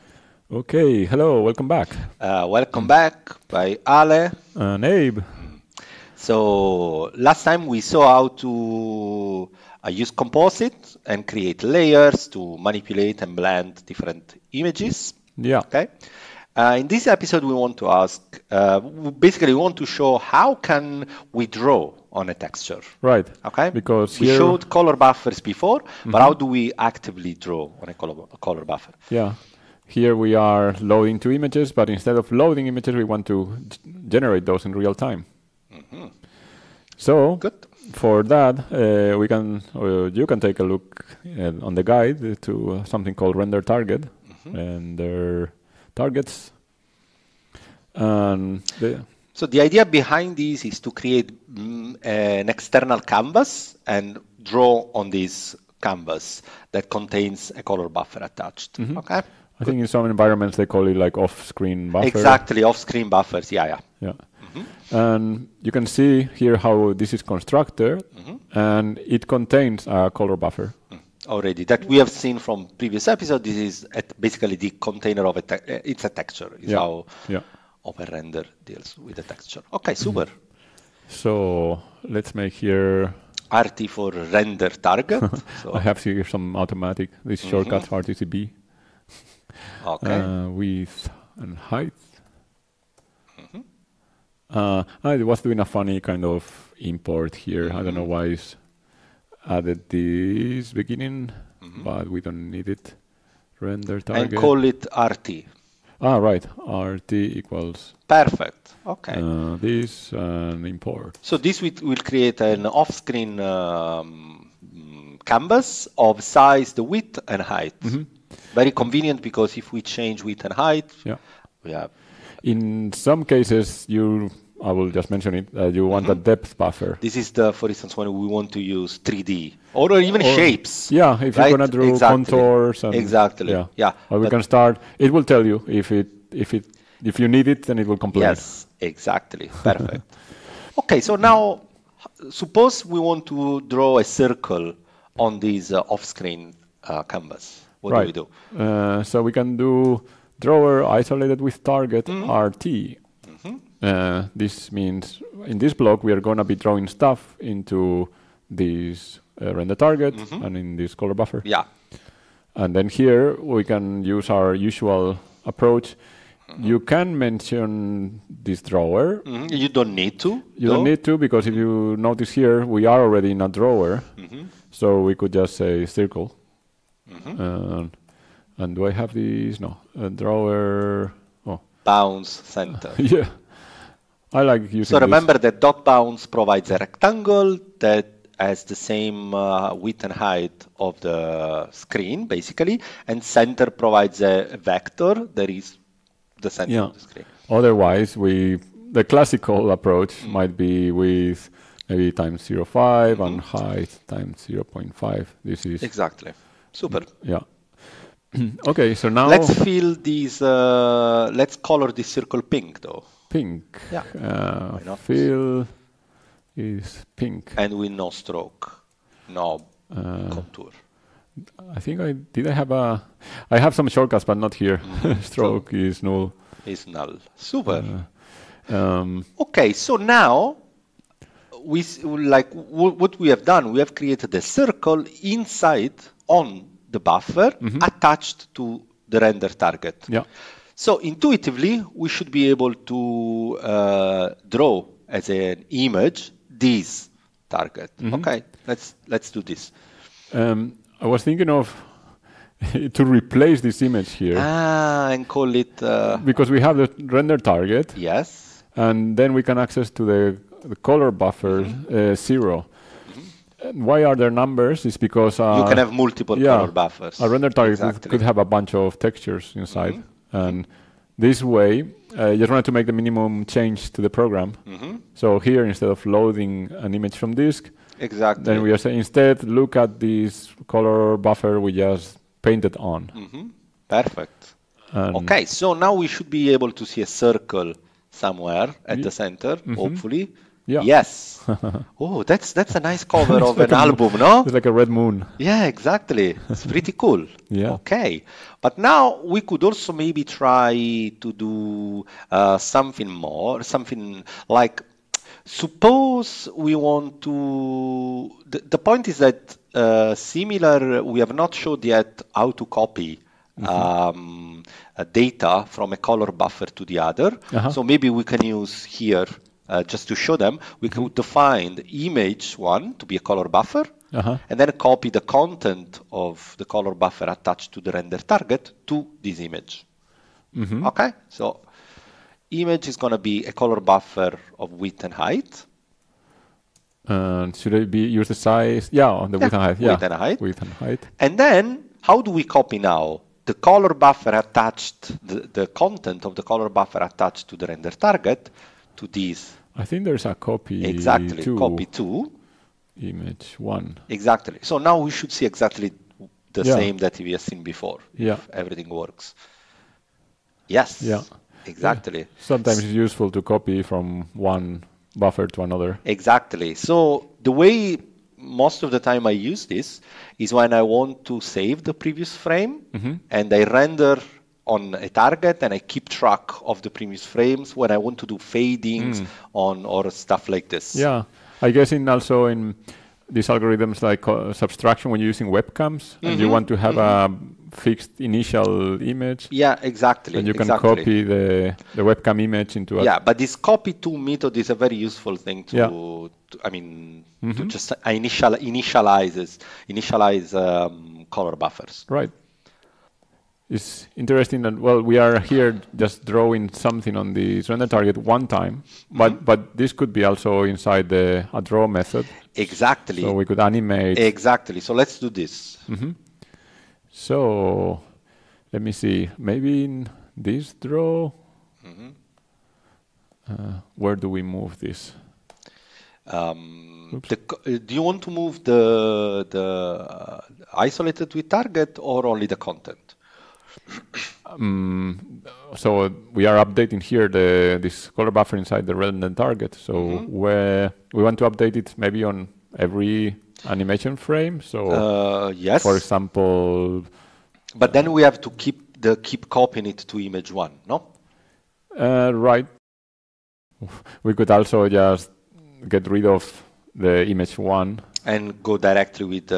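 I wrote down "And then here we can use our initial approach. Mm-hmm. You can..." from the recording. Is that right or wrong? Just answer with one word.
wrong.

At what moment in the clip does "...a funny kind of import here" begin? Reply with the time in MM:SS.
01:35.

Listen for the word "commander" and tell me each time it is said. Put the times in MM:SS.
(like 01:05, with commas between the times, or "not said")
not said.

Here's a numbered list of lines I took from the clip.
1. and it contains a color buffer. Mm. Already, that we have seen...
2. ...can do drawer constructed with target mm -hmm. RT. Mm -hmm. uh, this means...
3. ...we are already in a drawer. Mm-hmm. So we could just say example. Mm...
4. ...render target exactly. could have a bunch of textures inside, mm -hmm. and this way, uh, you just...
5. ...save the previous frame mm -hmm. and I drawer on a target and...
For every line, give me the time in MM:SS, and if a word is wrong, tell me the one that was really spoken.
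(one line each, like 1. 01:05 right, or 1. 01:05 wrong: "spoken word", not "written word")
1. 01:08 right
2. 02:29 wrong: "isolated", not "constructed"
3. 02:52 wrong: "circle", not "example"
4. 04:27 right
5. 06:11 wrong: "render", not "drawer".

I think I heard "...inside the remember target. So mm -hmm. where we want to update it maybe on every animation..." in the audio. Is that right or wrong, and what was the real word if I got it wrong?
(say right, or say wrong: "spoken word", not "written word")
wrong: "render", not "remember".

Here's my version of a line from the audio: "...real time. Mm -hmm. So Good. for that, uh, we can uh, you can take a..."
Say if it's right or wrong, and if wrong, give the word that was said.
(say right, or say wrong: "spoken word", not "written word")
right.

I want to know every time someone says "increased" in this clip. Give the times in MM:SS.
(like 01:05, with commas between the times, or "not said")
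not said.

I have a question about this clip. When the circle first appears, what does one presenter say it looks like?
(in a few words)
red moon.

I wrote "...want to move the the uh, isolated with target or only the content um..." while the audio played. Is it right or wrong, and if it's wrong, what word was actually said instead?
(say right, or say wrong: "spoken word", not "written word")
right.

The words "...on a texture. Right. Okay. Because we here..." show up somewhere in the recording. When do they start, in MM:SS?
00:22.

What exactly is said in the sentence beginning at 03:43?
I have some shortcuts, but not here.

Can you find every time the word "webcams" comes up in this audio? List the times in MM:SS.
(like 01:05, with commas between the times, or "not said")
06:25, 06:32.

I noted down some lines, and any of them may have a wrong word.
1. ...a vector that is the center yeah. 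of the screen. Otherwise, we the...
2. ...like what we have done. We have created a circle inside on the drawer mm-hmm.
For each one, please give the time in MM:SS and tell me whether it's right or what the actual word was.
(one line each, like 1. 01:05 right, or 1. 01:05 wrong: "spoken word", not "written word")
1. 03:14 right
2. 03:52 wrong: "buffer", not "drawer".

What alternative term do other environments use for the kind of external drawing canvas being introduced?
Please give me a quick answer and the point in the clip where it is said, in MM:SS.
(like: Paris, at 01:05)
off-screen buffer, at 01:01.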